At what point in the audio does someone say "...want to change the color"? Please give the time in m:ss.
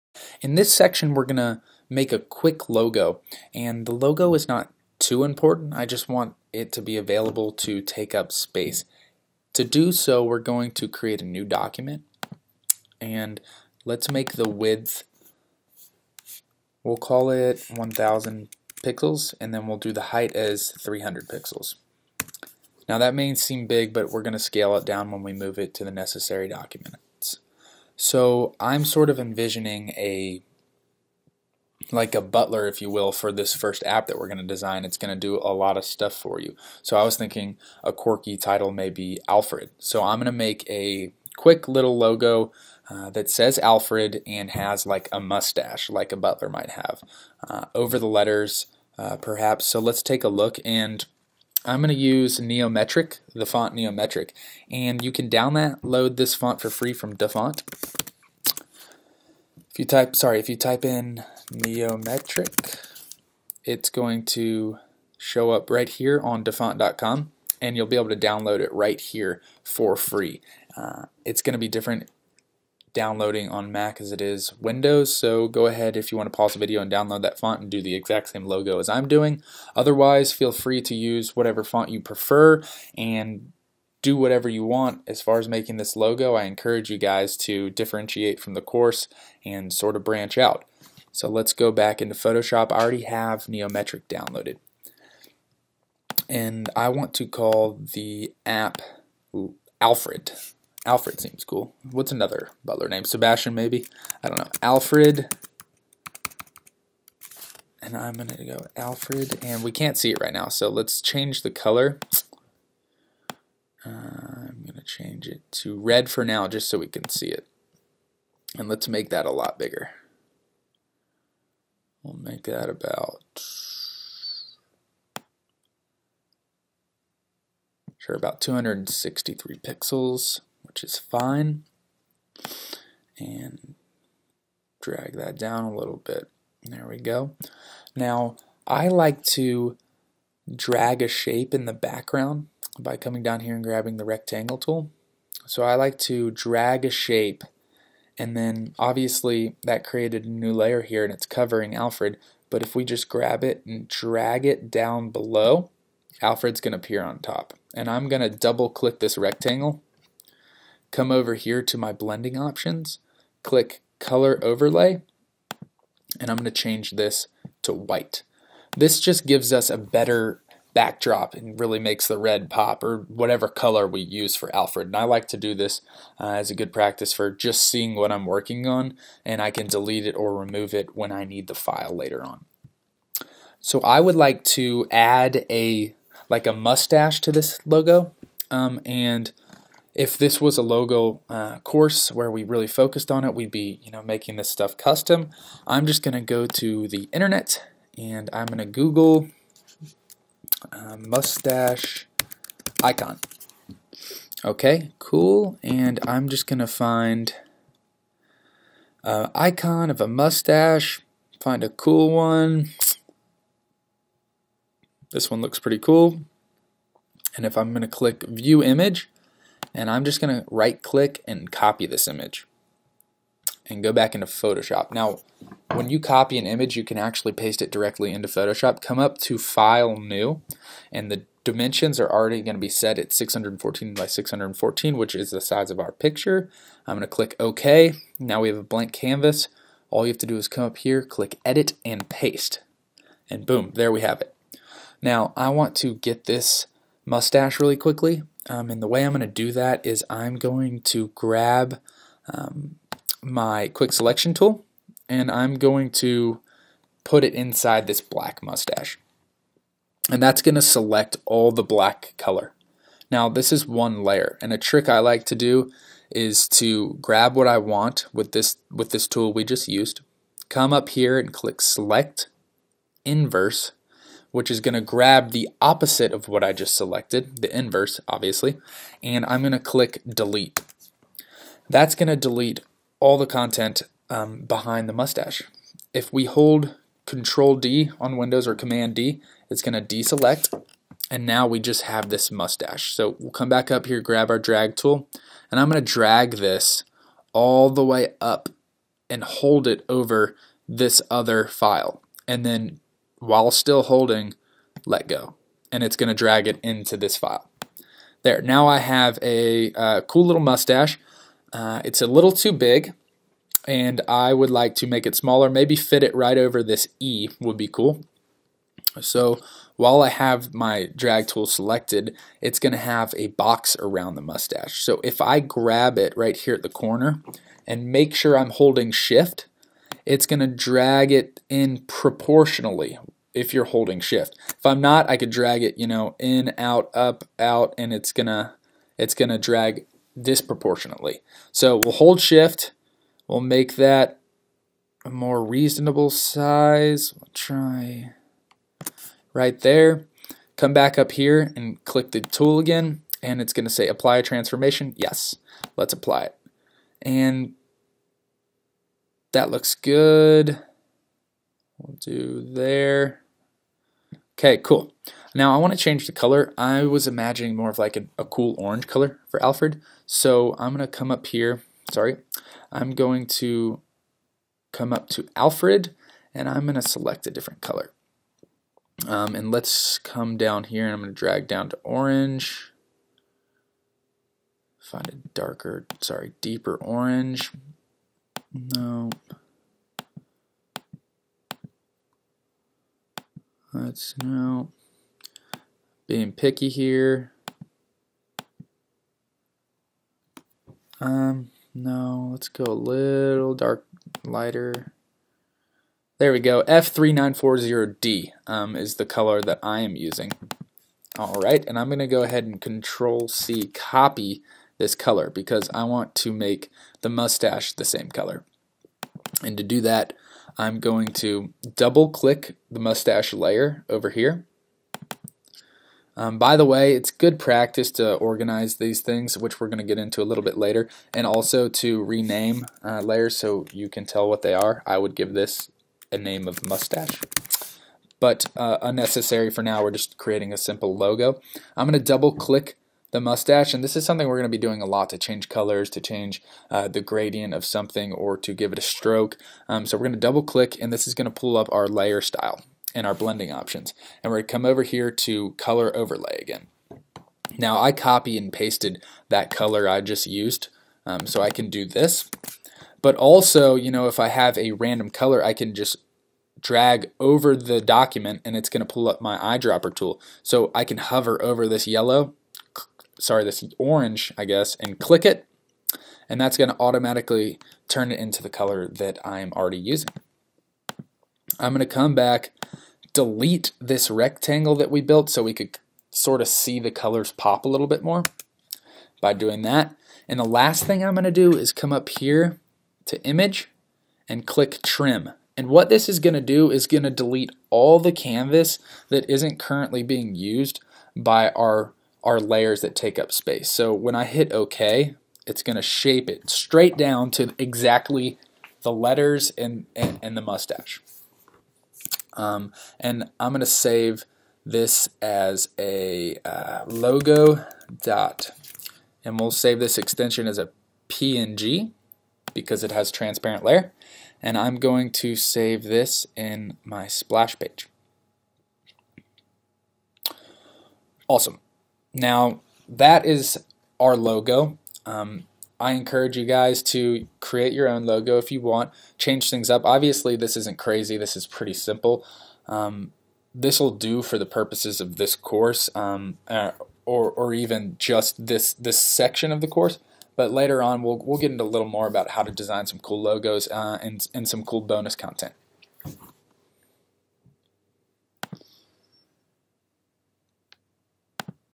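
6:05.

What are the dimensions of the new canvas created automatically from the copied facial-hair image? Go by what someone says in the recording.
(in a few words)
614 by 614.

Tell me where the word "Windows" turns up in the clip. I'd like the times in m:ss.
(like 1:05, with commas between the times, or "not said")
1:14, 4:48.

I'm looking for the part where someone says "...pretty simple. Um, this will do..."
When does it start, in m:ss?
9:01.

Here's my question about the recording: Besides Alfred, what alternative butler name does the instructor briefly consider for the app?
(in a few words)
Sebastian.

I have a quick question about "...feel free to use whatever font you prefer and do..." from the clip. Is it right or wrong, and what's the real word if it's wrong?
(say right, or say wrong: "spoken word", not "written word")
right.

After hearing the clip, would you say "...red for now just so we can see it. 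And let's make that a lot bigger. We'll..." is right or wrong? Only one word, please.
right.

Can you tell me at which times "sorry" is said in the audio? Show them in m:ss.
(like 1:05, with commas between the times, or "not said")
1:00, 6:11, 6:26, 7:53.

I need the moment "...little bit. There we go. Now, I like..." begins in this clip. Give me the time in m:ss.
2:15.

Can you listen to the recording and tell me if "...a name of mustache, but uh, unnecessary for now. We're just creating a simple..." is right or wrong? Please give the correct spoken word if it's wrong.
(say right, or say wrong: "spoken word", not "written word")
right.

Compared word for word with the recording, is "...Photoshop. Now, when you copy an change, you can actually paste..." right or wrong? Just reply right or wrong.
wrong.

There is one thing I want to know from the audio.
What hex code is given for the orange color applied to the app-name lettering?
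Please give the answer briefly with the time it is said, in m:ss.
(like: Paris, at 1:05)
F3940D, at 6:46.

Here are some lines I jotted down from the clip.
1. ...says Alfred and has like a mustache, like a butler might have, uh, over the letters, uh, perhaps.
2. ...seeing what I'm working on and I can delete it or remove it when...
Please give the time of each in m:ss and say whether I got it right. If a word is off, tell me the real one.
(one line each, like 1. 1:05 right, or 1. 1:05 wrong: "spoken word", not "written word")
1. 0:43 right
2. 2:57 right.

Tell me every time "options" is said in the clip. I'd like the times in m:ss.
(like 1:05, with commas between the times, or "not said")
2:42, 7:33.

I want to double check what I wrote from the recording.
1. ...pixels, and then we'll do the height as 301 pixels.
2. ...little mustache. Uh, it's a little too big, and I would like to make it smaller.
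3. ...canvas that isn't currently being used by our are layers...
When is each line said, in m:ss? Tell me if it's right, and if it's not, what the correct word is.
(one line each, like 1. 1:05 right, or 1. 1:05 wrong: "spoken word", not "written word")
1. 0:18 wrong: "300", not "301"
2. 5:10 right
3. 8:18 right.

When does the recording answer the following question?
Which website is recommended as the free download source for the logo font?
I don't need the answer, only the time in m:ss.
1:06.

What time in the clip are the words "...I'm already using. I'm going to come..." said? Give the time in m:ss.
7:59.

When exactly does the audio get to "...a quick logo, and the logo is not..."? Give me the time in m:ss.
0:02.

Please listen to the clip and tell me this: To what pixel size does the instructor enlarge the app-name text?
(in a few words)
263 pixels.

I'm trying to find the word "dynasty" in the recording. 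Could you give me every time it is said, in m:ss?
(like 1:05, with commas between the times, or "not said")
not said.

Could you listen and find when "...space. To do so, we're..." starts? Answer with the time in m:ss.
0:08.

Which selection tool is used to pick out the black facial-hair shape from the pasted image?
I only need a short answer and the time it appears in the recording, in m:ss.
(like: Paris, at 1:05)
quick selection tool, at 4:13.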